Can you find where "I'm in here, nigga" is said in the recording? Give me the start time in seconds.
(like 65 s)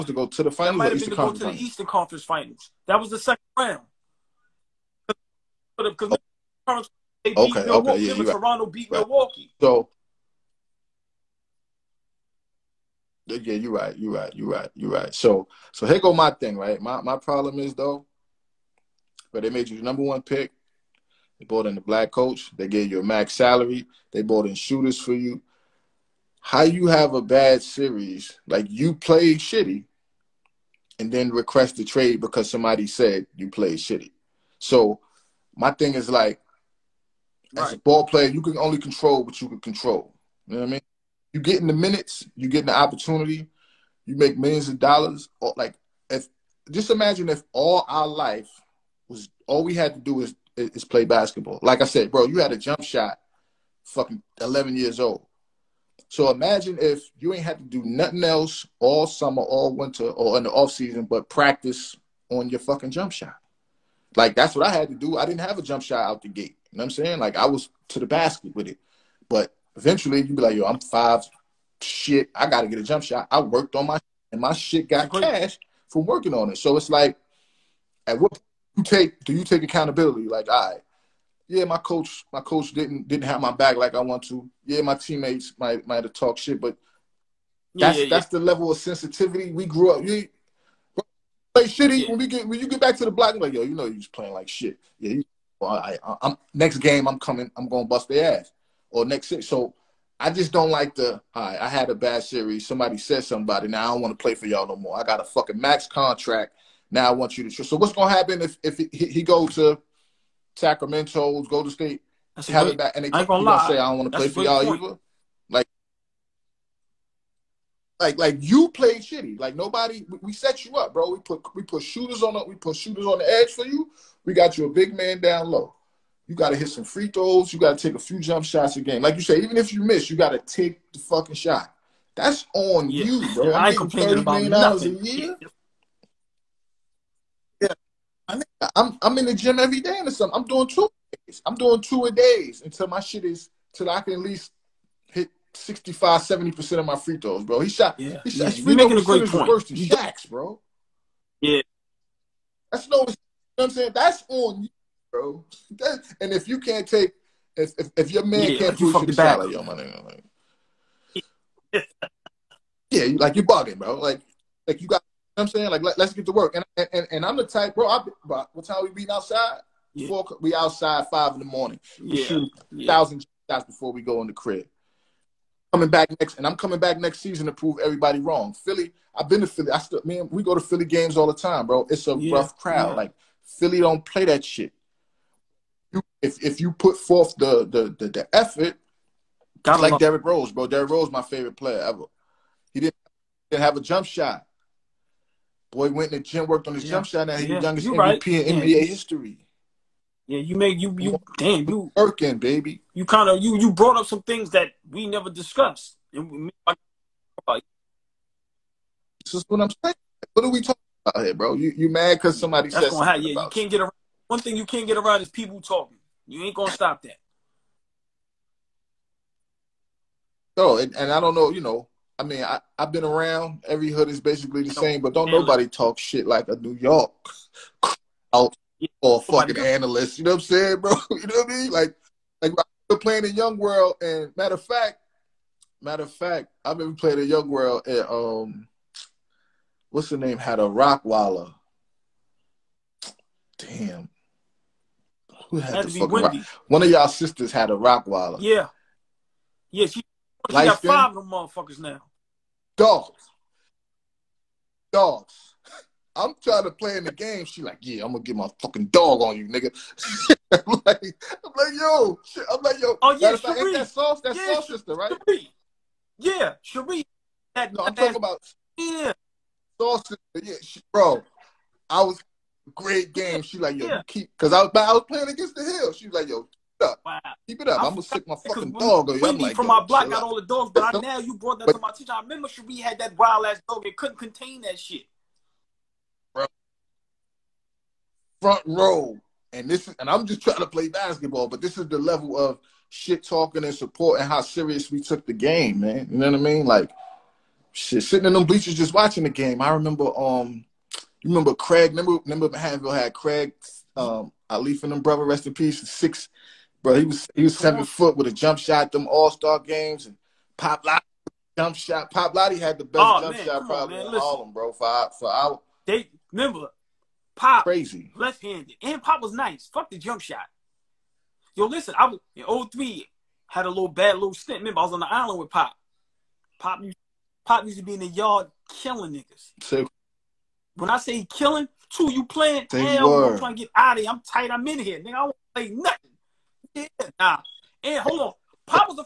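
334 s.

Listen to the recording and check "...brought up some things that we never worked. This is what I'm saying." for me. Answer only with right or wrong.
wrong.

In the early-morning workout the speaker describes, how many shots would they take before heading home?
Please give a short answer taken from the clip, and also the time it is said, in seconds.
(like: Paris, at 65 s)
1000, at 172 s.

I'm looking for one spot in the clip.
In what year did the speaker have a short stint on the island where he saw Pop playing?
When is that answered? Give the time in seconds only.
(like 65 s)
322 s.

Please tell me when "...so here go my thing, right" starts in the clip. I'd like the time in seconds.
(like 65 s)
15 s.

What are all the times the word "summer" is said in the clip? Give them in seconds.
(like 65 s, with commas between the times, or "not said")
59 s.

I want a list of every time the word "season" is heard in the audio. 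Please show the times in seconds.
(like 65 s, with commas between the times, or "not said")
60 s, 177 s.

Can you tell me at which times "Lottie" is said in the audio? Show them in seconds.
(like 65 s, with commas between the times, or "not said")
312 s.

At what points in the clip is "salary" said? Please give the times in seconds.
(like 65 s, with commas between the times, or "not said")
23 s, 159 s.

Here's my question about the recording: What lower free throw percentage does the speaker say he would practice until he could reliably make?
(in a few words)
65.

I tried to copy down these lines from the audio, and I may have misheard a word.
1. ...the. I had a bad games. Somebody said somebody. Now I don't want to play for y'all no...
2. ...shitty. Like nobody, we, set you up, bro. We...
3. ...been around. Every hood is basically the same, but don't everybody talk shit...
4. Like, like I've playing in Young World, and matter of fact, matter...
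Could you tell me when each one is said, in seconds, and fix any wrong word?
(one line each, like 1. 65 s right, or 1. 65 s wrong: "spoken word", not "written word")
1. 100 s wrong: "series", not "games"
2. 119 s right
3. 222 s wrong: "nobody", not "everybody"
4. 231 s right.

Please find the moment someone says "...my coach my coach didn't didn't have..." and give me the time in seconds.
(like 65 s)
81 s.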